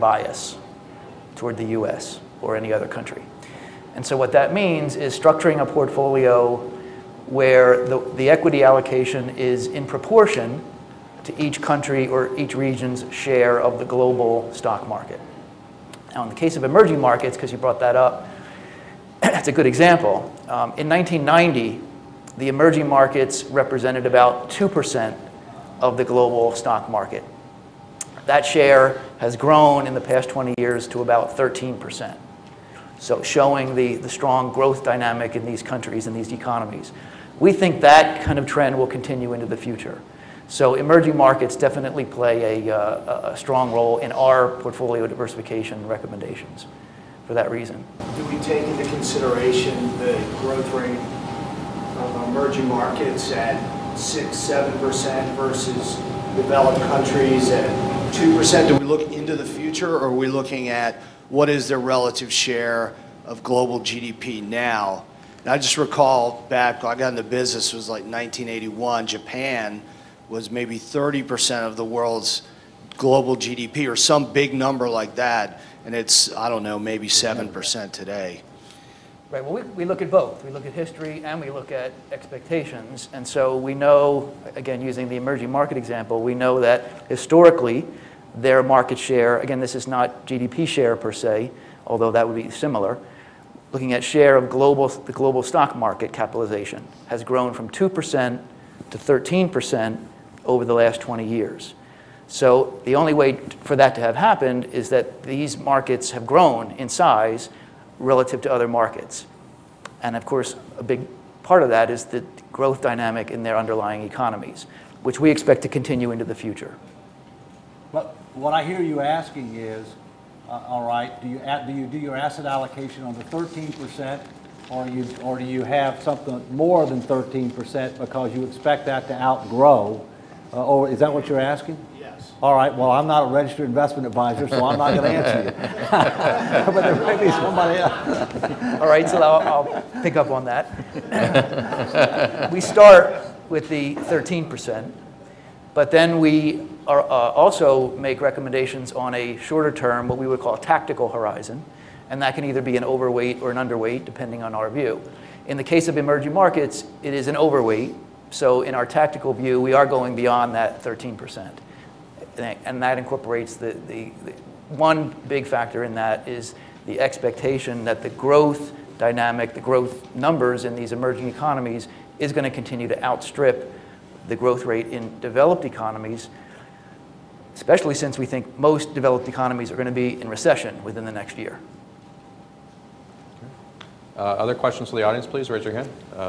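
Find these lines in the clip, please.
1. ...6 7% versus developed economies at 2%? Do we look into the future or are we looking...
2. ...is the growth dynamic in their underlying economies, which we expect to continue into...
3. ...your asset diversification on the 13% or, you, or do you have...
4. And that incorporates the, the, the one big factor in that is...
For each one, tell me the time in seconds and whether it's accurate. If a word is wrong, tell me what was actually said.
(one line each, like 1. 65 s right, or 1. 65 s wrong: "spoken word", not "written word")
1. 53 s wrong: "countries", not "economies"
2. 111 s right
3. 121 s wrong: "allocation", not "diversification"
4. 162 s right.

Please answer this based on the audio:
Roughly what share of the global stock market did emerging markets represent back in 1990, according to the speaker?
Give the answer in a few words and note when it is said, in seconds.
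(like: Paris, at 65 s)
2%, at 24 s.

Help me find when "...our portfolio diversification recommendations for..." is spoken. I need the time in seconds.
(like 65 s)
44 s.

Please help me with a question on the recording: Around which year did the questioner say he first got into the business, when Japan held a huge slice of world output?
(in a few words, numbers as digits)
1981.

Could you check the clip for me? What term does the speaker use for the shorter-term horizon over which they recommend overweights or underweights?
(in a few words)
tactical horizon.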